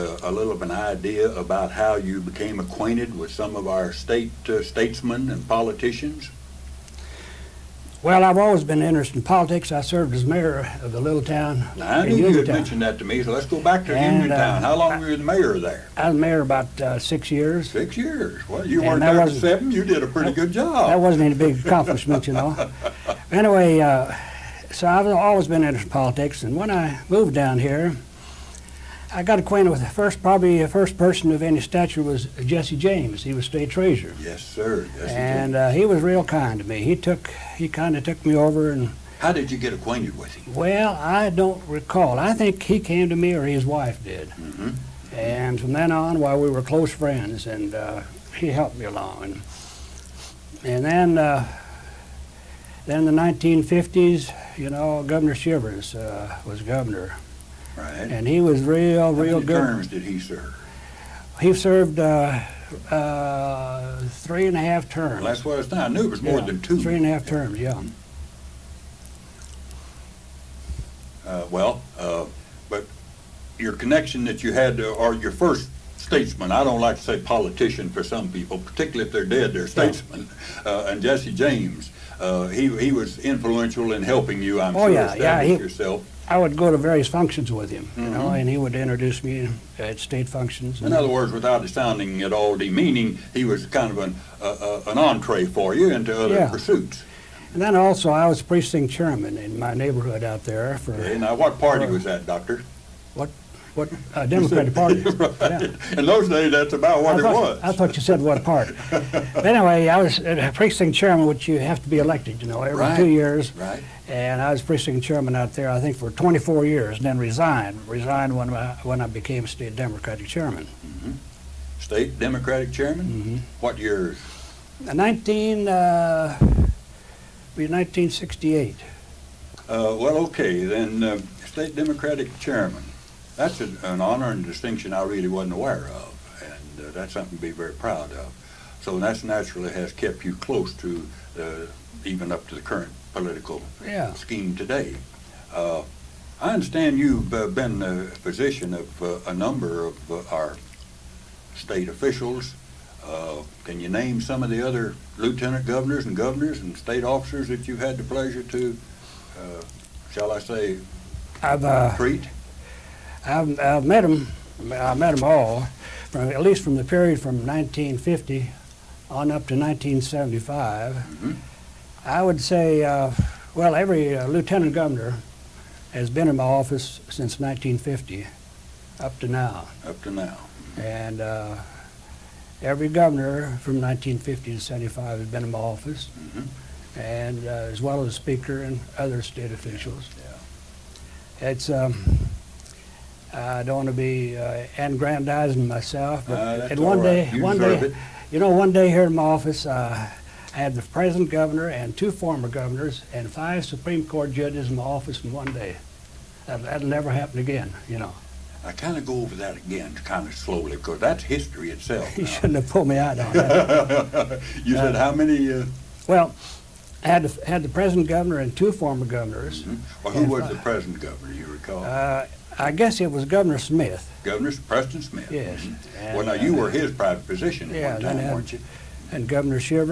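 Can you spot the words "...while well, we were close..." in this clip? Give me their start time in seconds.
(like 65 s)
46 s.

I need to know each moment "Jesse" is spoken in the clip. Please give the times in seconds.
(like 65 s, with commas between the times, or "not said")
32 s, 81 s.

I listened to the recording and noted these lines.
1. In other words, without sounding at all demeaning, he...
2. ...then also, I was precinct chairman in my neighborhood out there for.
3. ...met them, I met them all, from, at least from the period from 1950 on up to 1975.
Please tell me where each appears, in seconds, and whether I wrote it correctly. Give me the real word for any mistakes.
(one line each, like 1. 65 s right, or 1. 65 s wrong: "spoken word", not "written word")
1. 90 s right
2. 97 s right
3. 163 s right.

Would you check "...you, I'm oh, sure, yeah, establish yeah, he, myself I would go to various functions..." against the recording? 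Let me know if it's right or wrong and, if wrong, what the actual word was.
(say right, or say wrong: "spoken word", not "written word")
wrong: "yourself", not "myself".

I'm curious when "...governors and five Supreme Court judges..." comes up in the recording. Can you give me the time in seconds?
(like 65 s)
202 s.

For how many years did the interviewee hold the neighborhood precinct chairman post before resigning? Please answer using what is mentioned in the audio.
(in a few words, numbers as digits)
24.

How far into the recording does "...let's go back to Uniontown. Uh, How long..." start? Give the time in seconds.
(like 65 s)
13 s.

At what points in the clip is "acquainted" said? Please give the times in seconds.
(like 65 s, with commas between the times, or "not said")
2 s, 29 s, 39 s.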